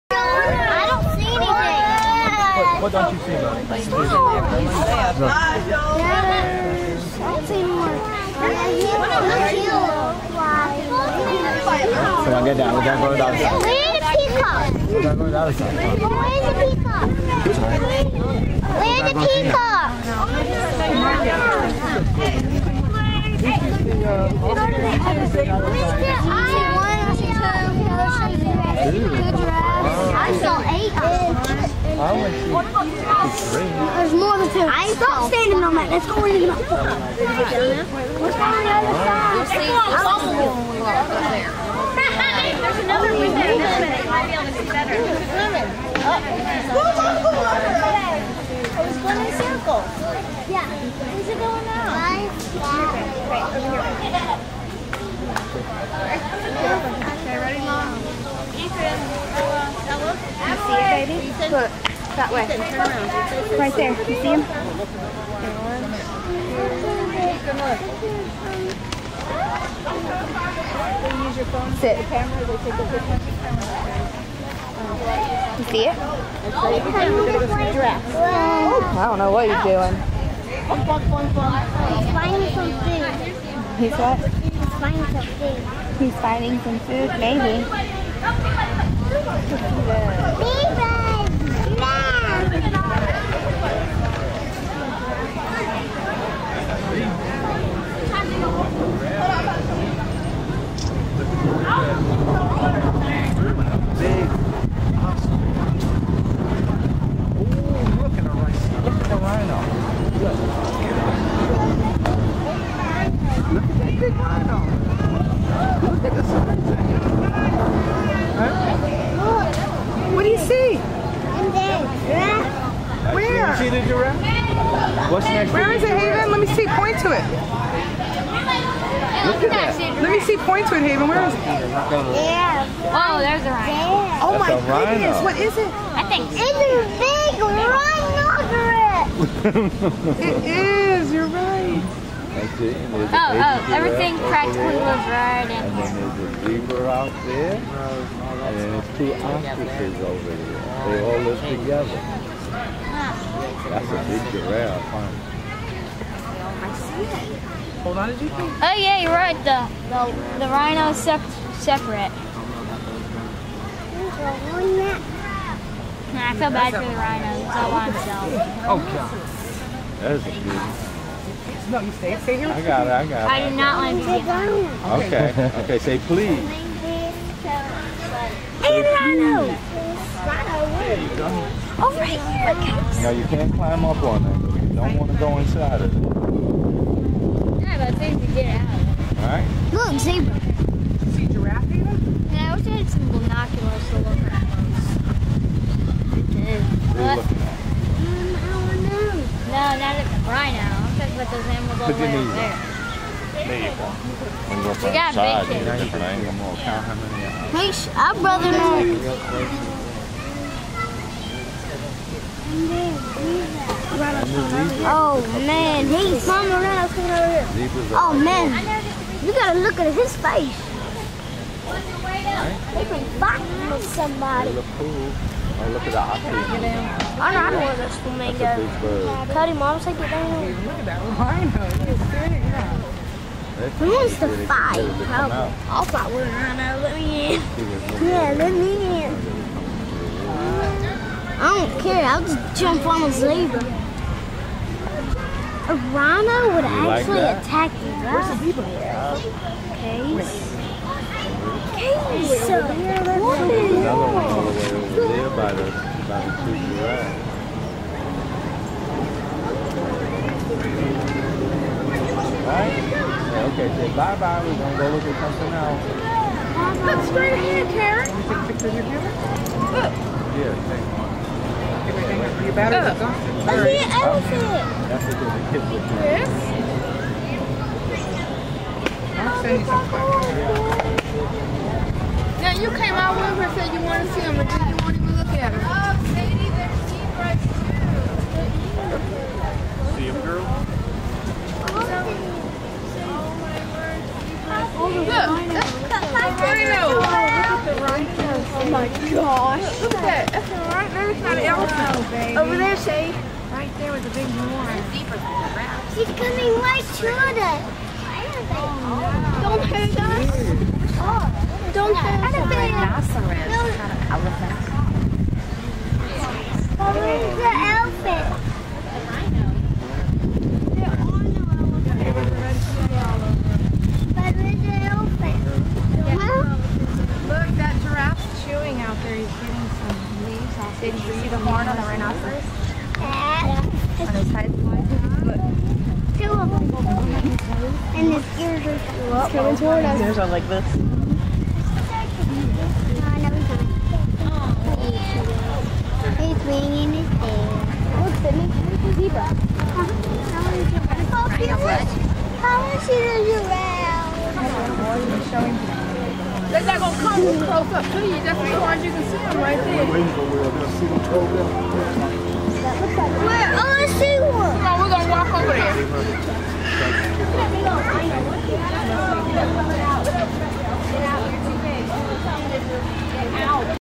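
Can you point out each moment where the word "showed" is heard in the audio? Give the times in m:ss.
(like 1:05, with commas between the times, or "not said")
not said.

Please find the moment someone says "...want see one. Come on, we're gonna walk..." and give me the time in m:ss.
6:03.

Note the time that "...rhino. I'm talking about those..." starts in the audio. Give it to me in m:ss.
3:20.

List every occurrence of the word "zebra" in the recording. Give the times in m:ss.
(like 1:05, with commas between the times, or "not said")
2:26, 3:10, 4:03, 5:48.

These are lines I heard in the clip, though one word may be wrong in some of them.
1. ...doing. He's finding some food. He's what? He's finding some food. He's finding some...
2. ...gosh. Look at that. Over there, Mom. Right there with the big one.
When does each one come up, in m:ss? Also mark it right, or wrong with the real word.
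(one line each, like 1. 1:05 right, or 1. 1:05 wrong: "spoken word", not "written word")
1. 1:19 right
2. 4:59 wrong: "Shay", not "Mom".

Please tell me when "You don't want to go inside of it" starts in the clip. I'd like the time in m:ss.
3:04.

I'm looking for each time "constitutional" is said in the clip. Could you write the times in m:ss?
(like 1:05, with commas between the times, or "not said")
not said.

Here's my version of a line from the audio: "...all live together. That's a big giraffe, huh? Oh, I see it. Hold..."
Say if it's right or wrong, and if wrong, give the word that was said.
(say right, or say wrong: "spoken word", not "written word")
right.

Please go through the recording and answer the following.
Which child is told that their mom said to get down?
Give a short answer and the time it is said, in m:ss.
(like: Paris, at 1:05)
Cody, at 3:49.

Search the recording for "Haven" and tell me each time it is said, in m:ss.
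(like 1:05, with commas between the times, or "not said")
2:05, 2:10.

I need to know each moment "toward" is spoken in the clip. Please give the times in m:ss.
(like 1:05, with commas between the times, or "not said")
5:06.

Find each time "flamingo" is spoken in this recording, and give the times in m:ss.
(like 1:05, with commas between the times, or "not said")
3:47.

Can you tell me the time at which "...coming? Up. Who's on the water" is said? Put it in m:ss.
0:45.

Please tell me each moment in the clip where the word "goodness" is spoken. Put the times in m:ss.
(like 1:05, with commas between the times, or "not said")
2:14.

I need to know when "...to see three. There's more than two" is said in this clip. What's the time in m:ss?
0:32.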